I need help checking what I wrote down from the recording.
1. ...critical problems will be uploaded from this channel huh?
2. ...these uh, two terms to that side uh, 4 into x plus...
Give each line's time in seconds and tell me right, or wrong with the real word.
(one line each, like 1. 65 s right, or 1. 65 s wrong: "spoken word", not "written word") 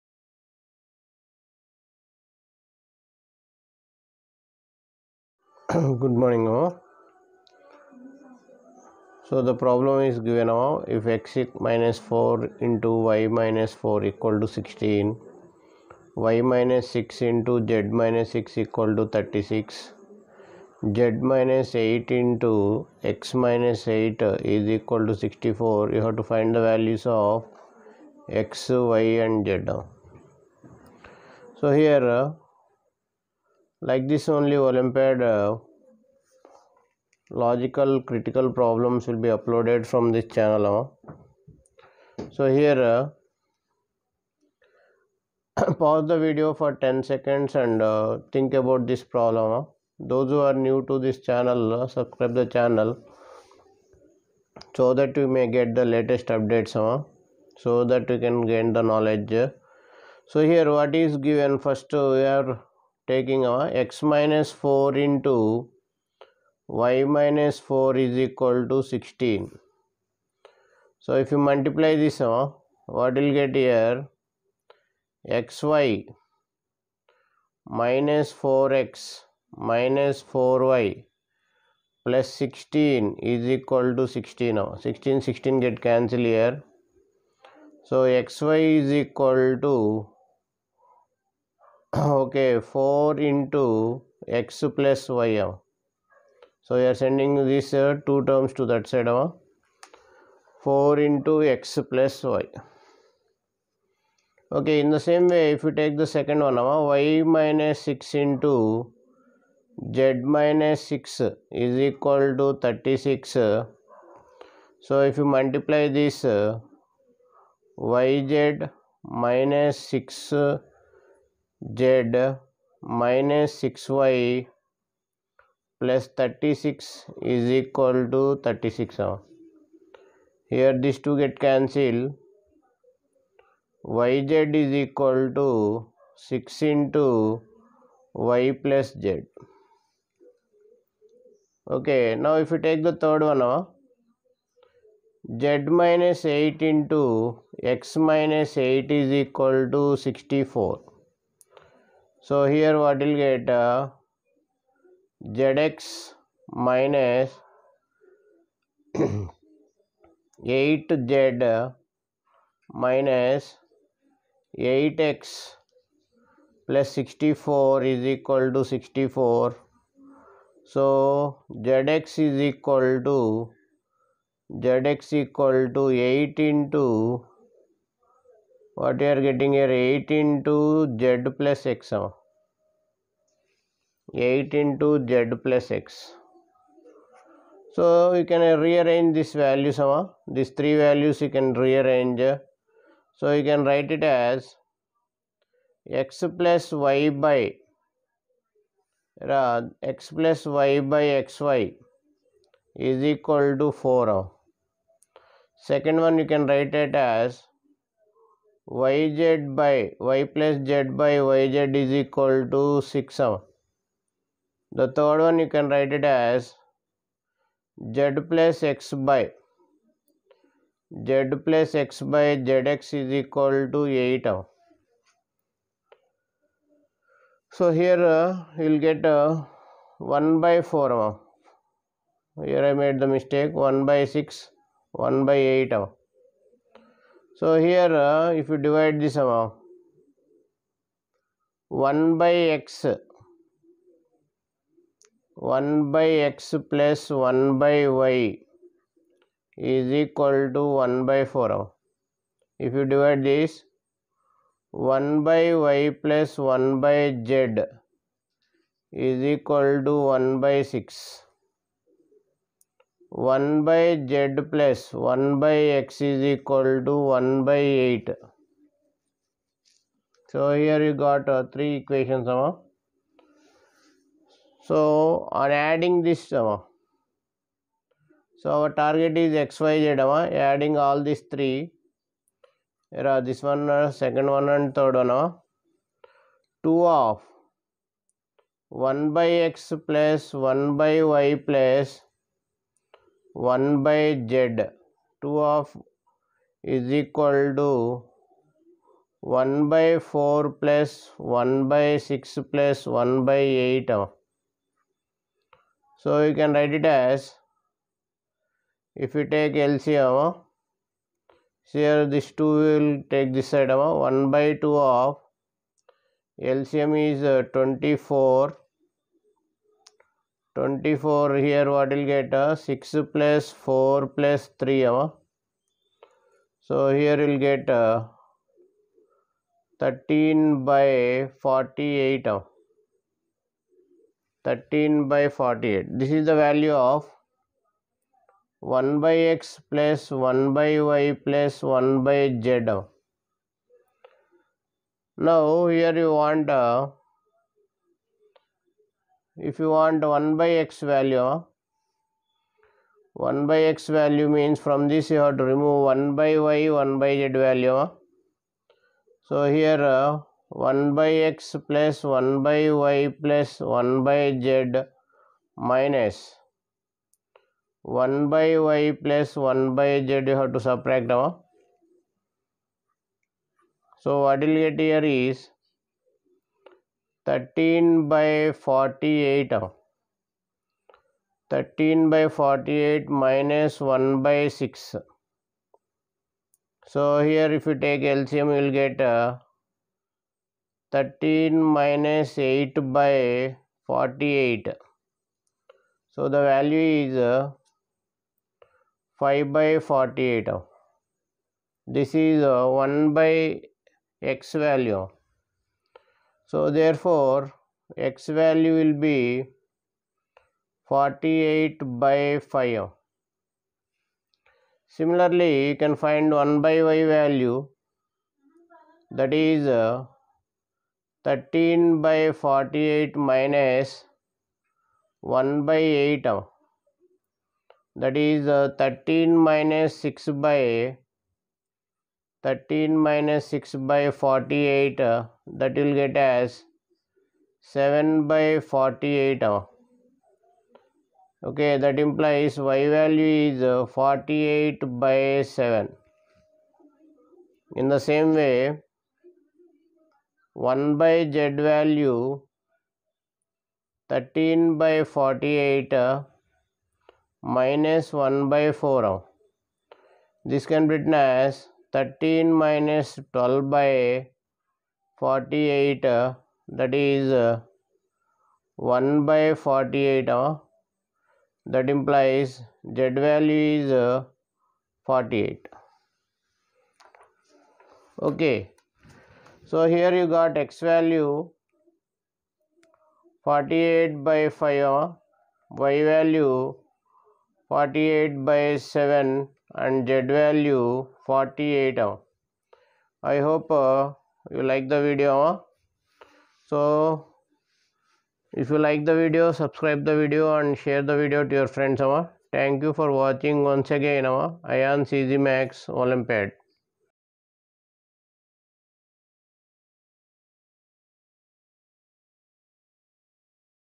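1. 38 s right
2. 97 s right.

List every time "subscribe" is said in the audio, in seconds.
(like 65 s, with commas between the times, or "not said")
51 s, 499 s.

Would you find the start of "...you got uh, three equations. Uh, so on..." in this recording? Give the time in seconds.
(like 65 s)
270 s.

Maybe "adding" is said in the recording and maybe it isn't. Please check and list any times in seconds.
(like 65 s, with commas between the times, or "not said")
275 s, 280 s.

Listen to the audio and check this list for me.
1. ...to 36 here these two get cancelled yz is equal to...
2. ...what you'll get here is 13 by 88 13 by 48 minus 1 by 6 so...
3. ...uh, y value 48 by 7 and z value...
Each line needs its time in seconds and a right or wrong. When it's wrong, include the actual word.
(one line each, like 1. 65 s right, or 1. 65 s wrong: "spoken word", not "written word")
1. 128 s right
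2. 374 s wrong: "48", not "88"
3. 484 s right.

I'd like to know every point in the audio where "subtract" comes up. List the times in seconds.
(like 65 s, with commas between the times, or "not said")
370 s.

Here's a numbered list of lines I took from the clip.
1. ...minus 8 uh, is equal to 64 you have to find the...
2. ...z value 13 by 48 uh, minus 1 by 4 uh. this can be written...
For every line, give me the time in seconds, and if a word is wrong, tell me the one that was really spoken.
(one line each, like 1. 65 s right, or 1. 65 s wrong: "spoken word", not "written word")
1. 23 s right
2. 451 s right.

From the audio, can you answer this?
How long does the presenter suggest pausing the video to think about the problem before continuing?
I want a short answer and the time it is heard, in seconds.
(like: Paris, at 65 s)
10 seconds, at 46 s.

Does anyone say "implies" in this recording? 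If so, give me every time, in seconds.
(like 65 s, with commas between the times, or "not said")
442 s, 471 s.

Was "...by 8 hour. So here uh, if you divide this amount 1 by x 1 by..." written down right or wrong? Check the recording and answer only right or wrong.
right.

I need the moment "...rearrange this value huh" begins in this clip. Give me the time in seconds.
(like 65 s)
188 s.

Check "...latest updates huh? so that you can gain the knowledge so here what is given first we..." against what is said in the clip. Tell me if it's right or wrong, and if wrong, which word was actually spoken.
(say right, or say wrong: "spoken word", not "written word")
right.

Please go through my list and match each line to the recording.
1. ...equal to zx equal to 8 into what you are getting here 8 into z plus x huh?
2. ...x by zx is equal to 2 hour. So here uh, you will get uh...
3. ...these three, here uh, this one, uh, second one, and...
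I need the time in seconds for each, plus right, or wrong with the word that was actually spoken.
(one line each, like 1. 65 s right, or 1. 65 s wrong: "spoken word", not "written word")
1. 172 s right
2. 221 s wrong: "8", not "2"
3. 281 s right.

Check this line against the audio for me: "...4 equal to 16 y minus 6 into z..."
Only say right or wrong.
right.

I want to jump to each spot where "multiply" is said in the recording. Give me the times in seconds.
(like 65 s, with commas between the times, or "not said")
71 s, 115 s.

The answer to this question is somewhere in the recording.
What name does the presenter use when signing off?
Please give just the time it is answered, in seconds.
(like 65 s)
505 s.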